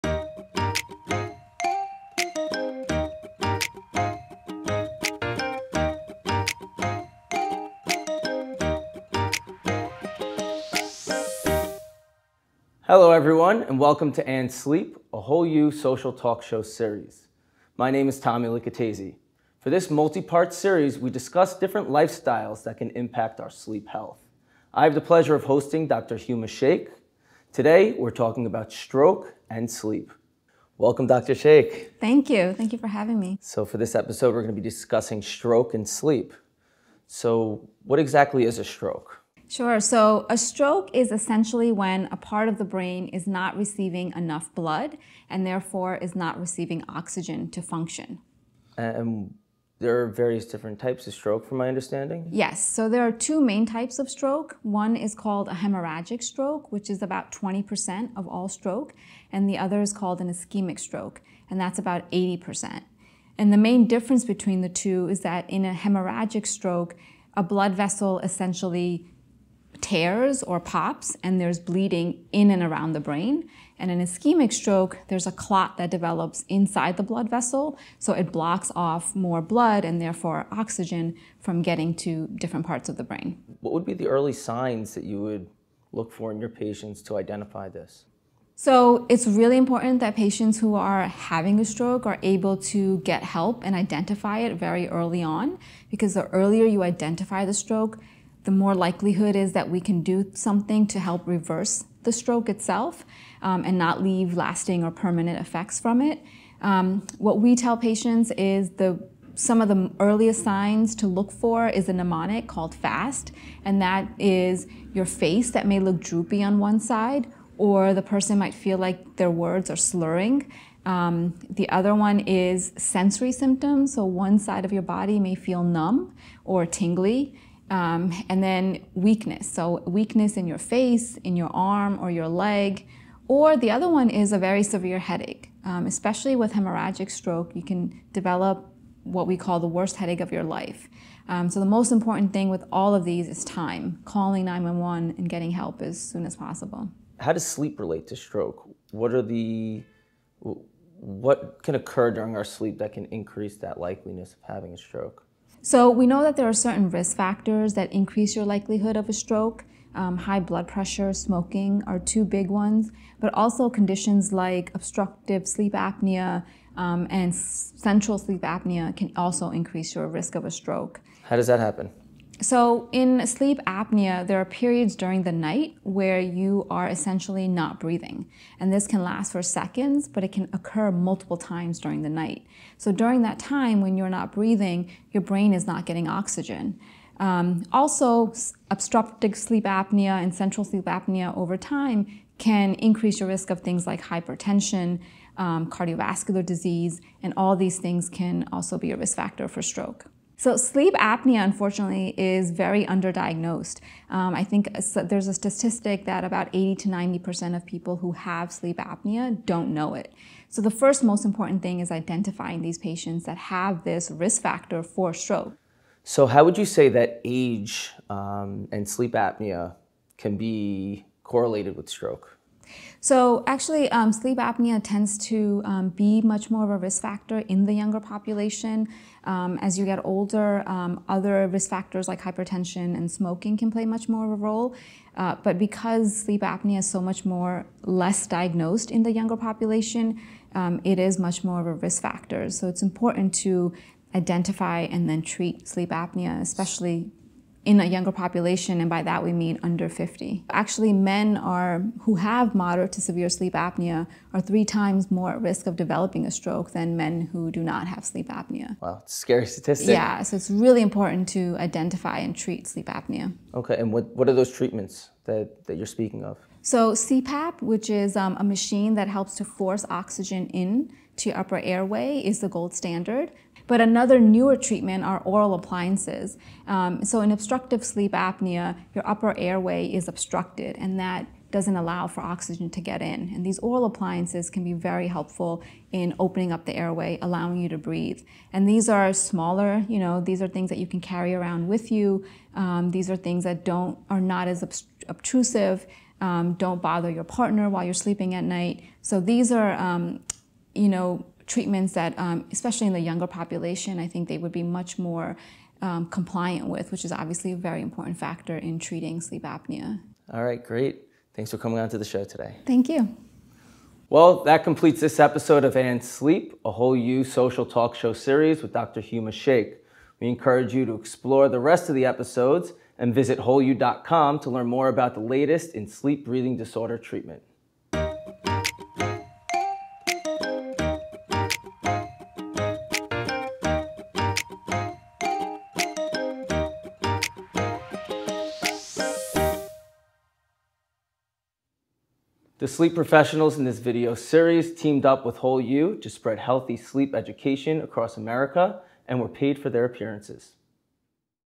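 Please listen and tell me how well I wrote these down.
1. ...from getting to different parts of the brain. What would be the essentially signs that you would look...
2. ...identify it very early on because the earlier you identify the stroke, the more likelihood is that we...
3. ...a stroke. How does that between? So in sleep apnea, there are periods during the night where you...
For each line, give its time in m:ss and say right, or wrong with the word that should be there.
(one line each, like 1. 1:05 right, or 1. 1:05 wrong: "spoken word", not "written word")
1. 1:21 wrong: "early", not "essentially"
2. 1:33 right
3. 2:50 wrong: "happen", not "between".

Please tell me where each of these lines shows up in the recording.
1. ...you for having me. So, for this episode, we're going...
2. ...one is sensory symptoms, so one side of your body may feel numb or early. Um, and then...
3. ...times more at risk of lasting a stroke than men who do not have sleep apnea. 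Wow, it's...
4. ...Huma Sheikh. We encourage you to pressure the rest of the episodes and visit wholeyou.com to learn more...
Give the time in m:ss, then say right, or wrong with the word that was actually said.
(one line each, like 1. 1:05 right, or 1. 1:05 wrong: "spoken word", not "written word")
1. 0:32 right
2. 2:01 wrong: "tingly", not "early"
3. 4:14 wrong: "developing", not "lasting"
4. 5:19 wrong: "explore", not "pressure".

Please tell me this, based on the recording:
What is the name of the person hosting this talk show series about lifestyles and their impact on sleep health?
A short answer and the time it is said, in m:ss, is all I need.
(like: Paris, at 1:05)
Tommy Licatese, at 0:18.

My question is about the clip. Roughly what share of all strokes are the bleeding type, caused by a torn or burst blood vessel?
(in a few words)
20%.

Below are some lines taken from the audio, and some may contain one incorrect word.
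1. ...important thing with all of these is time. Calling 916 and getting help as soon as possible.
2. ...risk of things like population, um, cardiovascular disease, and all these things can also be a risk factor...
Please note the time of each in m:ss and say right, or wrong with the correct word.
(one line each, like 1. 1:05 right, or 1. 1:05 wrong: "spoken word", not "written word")
1. 2:21 wrong: "911", not "916"
2. 3:13 wrong: "hypertension", not "population".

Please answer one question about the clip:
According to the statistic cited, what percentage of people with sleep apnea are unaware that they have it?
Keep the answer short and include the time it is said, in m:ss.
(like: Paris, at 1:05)
80 to 90%, at 3:26.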